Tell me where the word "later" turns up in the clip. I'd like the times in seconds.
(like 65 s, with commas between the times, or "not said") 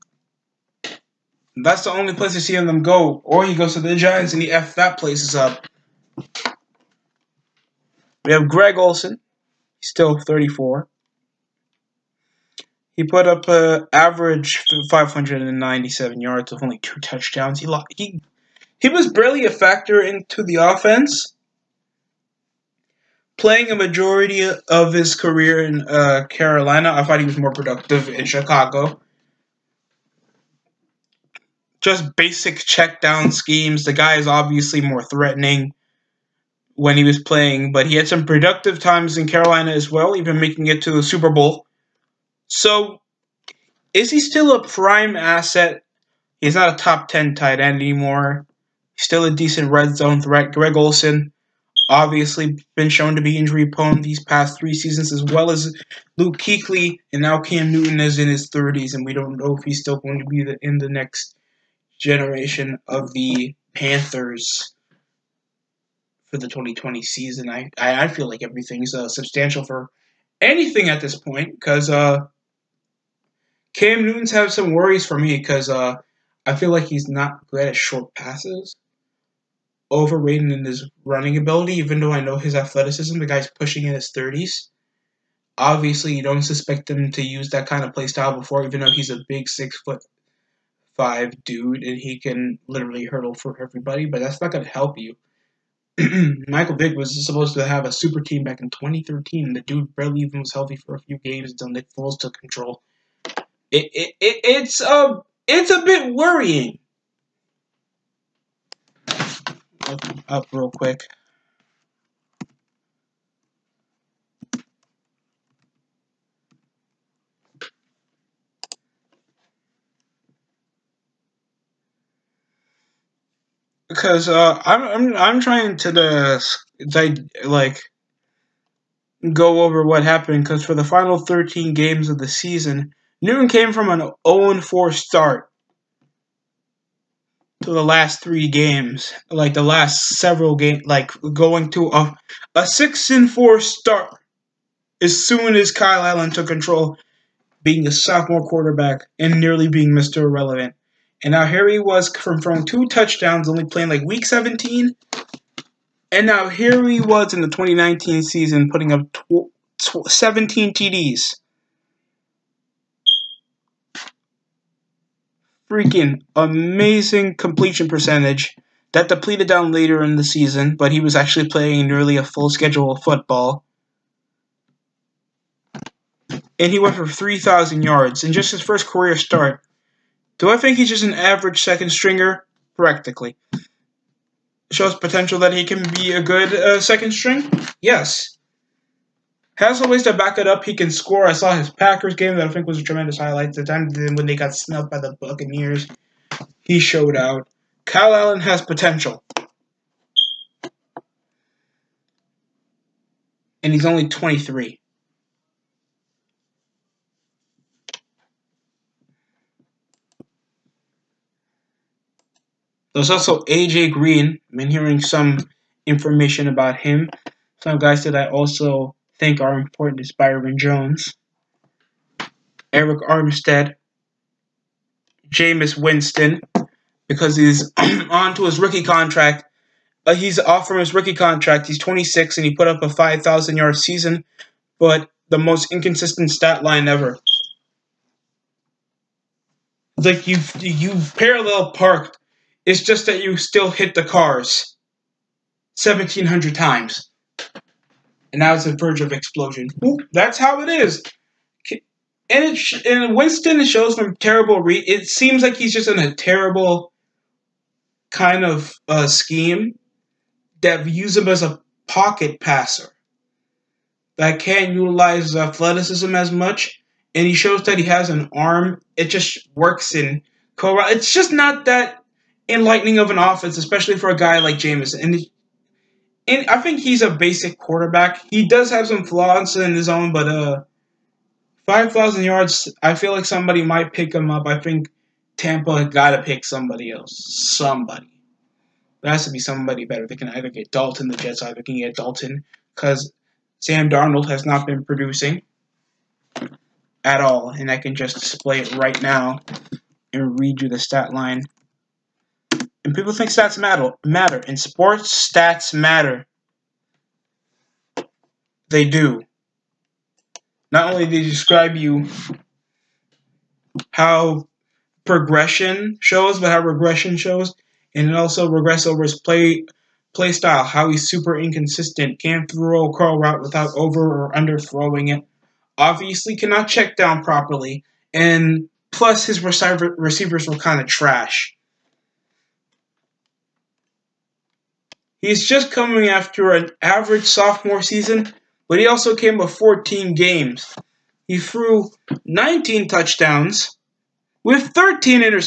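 169 s.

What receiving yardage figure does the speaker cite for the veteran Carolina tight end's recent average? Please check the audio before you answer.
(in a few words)
597.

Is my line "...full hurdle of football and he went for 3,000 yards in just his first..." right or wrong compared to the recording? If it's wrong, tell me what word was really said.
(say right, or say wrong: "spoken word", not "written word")
wrong: "schedule", not "hurdle".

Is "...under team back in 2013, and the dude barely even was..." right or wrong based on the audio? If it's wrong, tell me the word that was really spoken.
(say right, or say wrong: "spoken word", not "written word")
wrong: "super", not "under".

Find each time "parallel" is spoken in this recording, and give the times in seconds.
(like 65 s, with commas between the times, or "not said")
241 s.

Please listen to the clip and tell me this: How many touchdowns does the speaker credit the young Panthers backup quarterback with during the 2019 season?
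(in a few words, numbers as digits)
17.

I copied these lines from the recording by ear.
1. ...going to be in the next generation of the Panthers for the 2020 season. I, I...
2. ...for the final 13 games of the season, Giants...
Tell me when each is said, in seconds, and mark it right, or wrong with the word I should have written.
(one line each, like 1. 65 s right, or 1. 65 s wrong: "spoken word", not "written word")
1. 59 s right
2. 130 s wrong: "Newton", not "Giants".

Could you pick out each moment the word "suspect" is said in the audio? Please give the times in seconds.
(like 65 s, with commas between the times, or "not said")
86 s.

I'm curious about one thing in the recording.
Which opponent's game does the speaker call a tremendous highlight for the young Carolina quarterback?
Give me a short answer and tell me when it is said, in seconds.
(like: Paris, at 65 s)
Packers, at 191 s.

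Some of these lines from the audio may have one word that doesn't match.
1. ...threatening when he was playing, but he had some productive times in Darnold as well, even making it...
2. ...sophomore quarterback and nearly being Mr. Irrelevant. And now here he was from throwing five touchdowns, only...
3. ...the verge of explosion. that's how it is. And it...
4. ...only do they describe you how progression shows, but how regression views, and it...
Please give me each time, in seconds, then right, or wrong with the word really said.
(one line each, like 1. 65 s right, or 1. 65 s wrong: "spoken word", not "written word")
1. 35 s wrong: "Carolina", not "Darnold"
2. 147 s wrong: "two", not "five"
3. 248 s right
4. 310 s wrong: "shows", not "views".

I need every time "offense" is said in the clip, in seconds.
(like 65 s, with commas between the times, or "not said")
20 s, 273 s.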